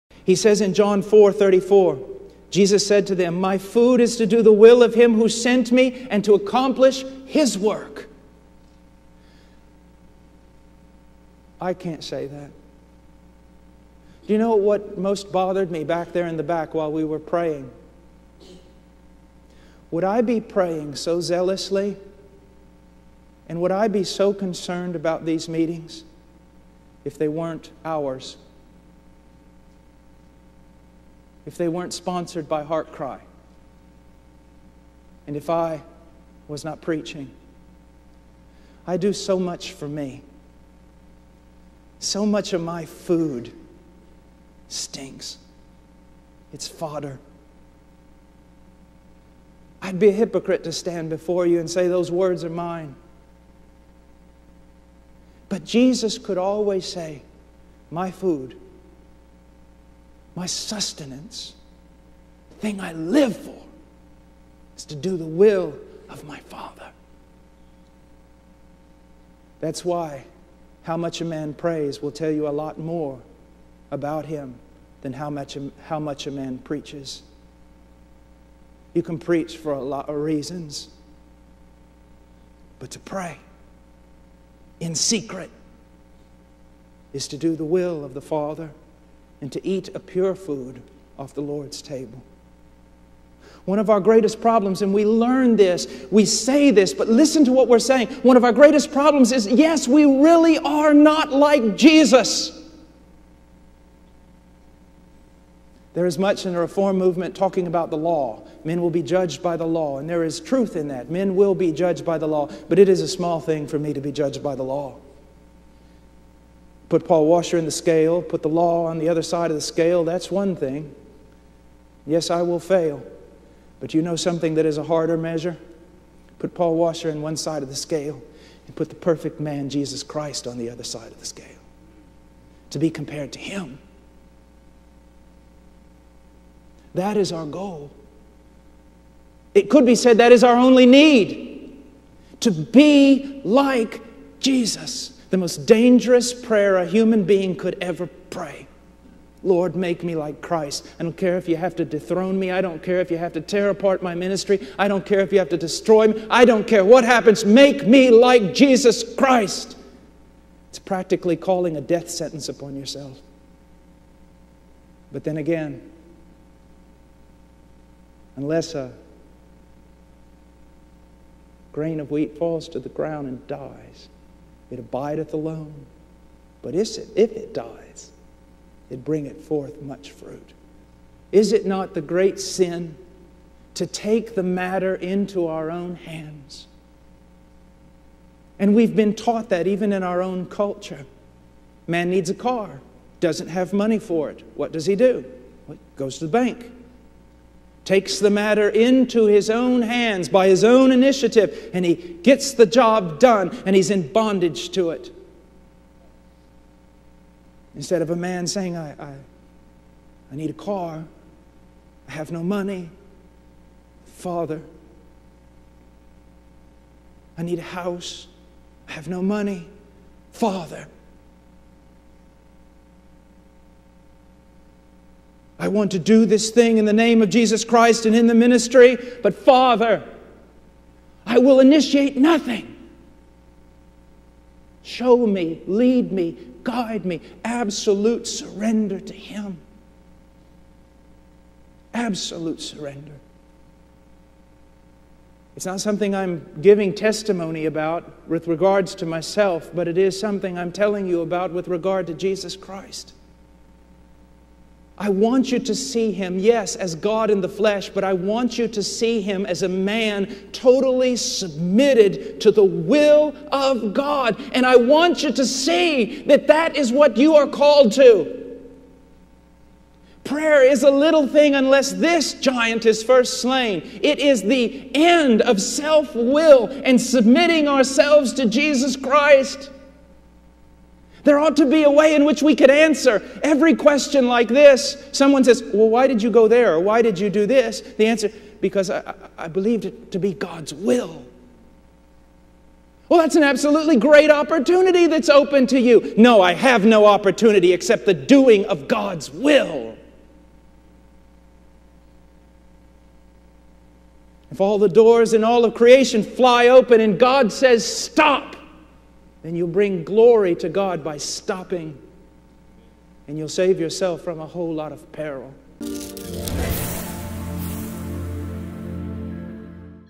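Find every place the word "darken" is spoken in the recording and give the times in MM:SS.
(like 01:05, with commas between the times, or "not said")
not said.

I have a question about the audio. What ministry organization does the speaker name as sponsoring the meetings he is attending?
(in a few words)
HeartCry.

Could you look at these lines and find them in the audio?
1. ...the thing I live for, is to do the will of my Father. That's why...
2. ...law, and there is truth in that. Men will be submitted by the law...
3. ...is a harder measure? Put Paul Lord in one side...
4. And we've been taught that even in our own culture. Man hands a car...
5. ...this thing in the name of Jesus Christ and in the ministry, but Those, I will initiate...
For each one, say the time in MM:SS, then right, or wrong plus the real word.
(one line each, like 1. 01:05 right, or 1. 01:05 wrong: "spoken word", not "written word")
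1. 01:02 right
2. 01:49 wrong: "judged", not "submitted"
3. 02:04 wrong: "Washer", not "Lord"
4. 03:08 wrong: "needs", not "hands"
5. 03:46 wrong: "Father", not "Those".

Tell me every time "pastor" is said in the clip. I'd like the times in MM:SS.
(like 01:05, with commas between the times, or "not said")
not said.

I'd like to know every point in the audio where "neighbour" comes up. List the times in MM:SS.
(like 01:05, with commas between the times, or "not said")
not said.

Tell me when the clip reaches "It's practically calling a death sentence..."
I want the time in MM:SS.
02:40.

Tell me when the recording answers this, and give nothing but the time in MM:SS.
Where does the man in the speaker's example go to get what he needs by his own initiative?
03:16.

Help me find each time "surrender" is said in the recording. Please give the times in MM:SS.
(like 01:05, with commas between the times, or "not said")
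03:58, 04:02.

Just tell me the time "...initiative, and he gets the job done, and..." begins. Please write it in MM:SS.
03:20.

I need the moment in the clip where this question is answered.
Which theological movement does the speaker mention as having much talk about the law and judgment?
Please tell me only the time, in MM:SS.
01:46.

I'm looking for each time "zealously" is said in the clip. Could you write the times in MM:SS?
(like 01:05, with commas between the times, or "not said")
00:21.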